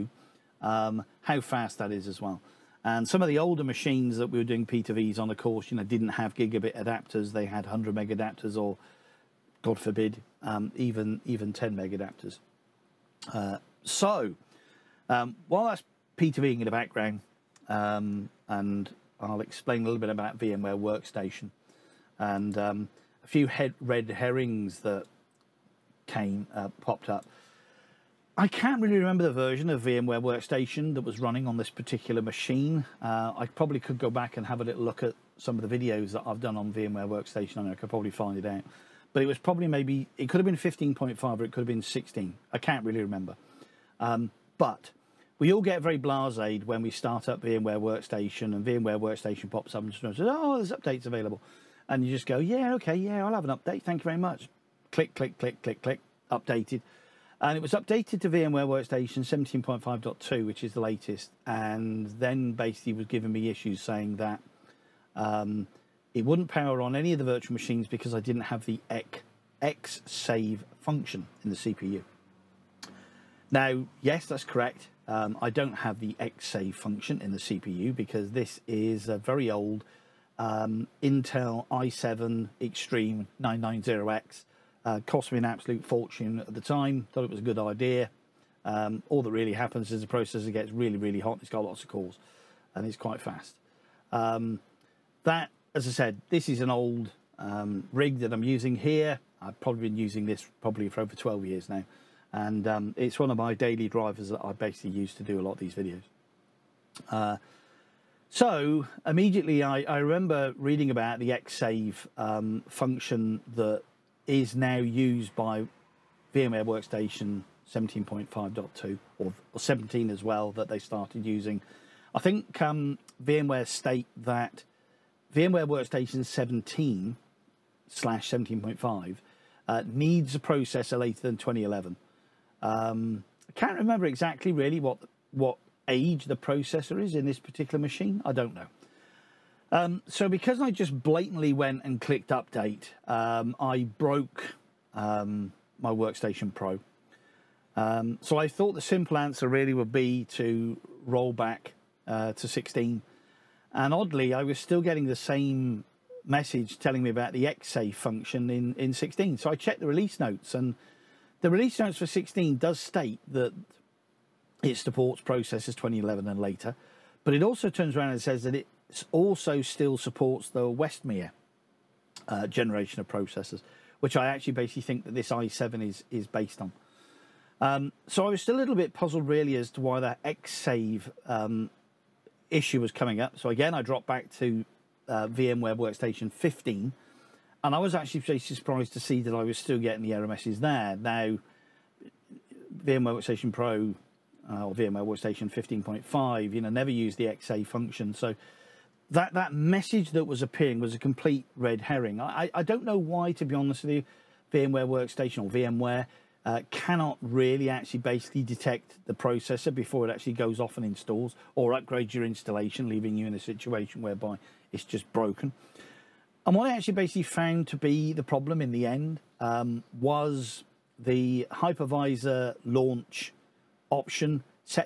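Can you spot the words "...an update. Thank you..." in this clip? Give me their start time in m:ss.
0:53.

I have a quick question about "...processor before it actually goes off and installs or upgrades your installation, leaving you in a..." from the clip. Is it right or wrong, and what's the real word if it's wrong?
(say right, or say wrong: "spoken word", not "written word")
right.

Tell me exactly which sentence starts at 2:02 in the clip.
I think um, VMware state that VMware Workstation 17 slash 17.5 uh, needs a processor later than 2011.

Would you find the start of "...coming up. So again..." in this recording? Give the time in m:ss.
3:02.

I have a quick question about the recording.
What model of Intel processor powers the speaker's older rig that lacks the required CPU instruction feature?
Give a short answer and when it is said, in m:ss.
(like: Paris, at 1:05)
i7 Extreme 990X, at 1:21.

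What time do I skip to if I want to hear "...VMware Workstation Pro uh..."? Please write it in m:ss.
3:12.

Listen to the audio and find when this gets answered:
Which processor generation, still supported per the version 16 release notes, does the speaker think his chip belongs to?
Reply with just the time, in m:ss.
2:50.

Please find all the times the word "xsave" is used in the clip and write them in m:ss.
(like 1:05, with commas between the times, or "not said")
1:51, 2:37, 3:00, 3:17.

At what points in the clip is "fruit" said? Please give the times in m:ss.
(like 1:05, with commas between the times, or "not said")
not said.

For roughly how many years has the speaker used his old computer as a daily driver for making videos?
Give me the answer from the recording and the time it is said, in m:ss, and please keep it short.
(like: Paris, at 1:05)
12, at 1:41.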